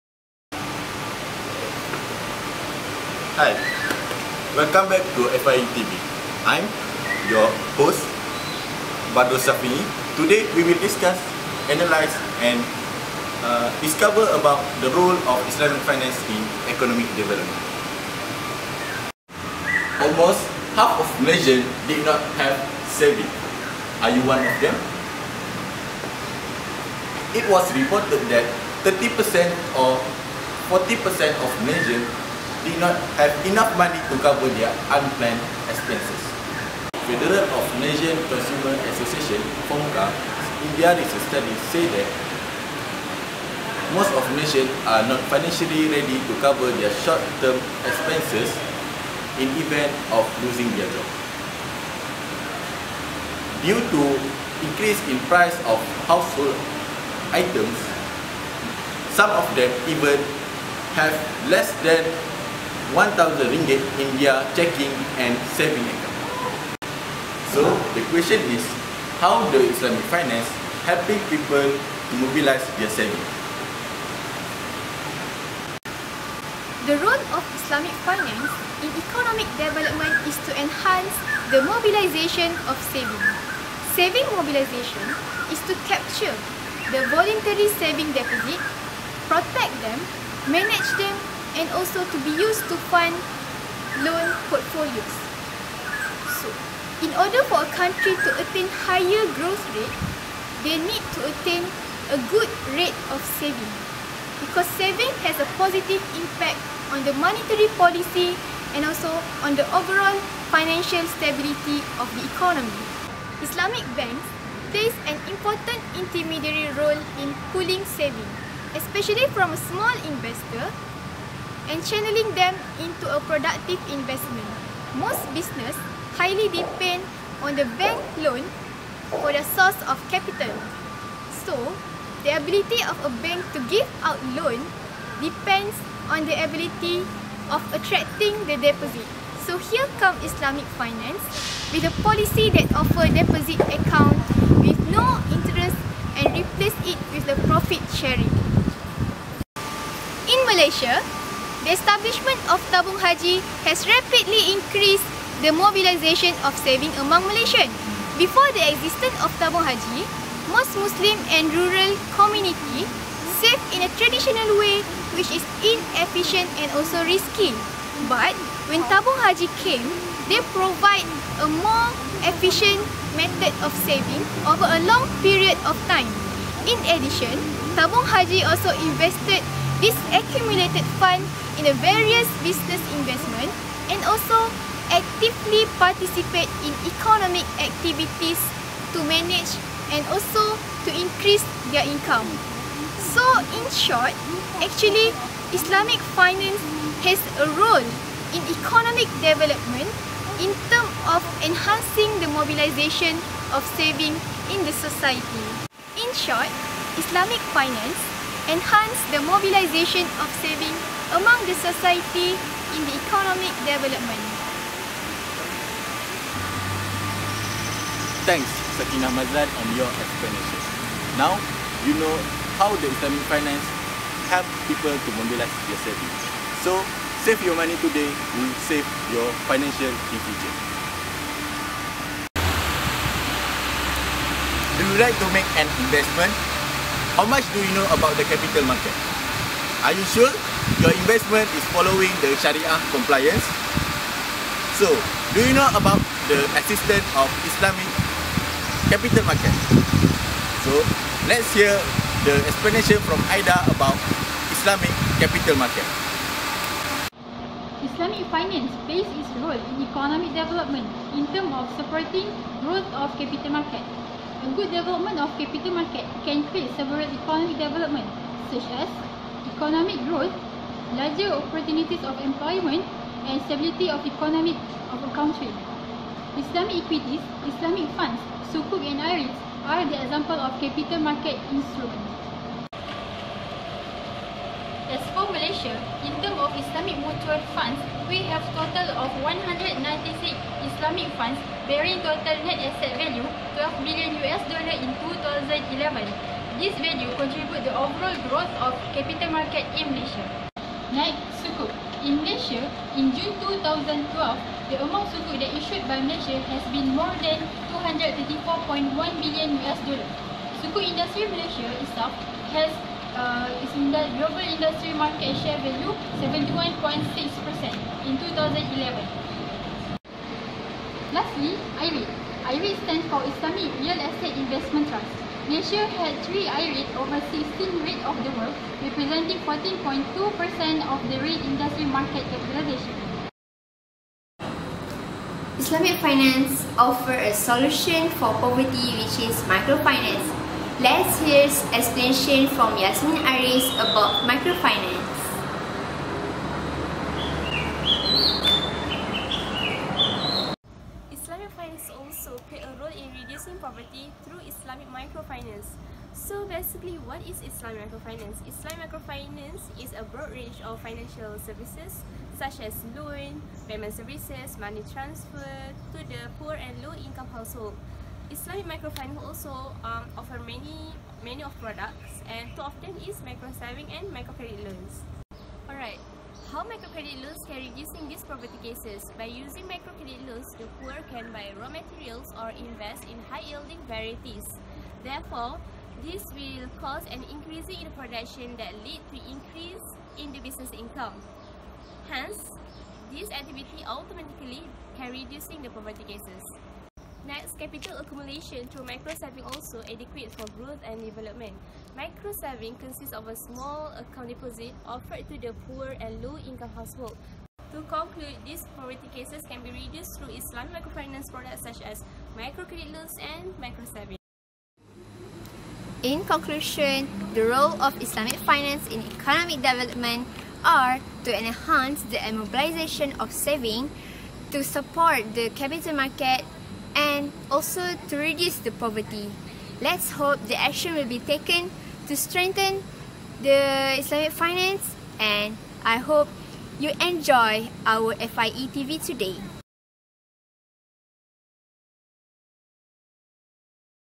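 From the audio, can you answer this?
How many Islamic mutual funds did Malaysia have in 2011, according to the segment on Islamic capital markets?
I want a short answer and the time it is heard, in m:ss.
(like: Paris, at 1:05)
196, at 4:49.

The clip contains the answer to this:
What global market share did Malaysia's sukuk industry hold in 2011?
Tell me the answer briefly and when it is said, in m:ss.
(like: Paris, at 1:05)
71.6%, at 5:16.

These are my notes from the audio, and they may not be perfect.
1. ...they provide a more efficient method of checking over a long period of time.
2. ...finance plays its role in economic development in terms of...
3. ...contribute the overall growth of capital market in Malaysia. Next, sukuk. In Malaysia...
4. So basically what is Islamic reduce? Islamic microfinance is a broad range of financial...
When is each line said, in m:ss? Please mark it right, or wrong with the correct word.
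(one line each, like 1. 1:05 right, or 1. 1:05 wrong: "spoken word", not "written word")
1. 2:50 wrong: "saving", not "checking"
2. 4:18 right
3. 4:57 right
4. 5:56 wrong: "microfinance", not "reduce".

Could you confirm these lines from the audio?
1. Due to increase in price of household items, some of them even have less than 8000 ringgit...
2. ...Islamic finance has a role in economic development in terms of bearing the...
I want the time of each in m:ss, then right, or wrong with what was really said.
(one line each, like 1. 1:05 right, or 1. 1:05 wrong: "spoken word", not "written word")
1. 0:53 wrong: "1000", not "8000"
2. 3:15 wrong: "enhancing", not "bearing".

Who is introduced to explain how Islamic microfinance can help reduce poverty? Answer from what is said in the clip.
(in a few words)
Yasmin Aris.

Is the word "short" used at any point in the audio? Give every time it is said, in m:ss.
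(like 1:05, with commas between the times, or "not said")
0:47, 3:13, 3:26.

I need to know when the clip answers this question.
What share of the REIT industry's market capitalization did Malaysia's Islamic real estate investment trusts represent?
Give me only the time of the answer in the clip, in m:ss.
5:29.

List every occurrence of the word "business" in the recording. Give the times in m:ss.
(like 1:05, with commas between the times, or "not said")
2:05, 3:02, 6:30.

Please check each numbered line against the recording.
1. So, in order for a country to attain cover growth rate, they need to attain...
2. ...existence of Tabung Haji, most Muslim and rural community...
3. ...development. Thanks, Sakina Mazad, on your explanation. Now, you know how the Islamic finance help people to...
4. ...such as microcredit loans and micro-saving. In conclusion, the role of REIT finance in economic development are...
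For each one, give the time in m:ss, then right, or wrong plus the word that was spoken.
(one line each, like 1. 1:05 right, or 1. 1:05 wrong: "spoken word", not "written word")
1. 1:36 wrong: "higher", not "cover"
2. 2:38 right
3. 3:33 right
4. 6:51 wrong: "Islamic", not "REIT".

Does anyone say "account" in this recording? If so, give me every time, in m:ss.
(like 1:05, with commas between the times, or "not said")
1:05, 2:23, 6:43.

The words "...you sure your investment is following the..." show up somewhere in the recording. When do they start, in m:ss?
3:59.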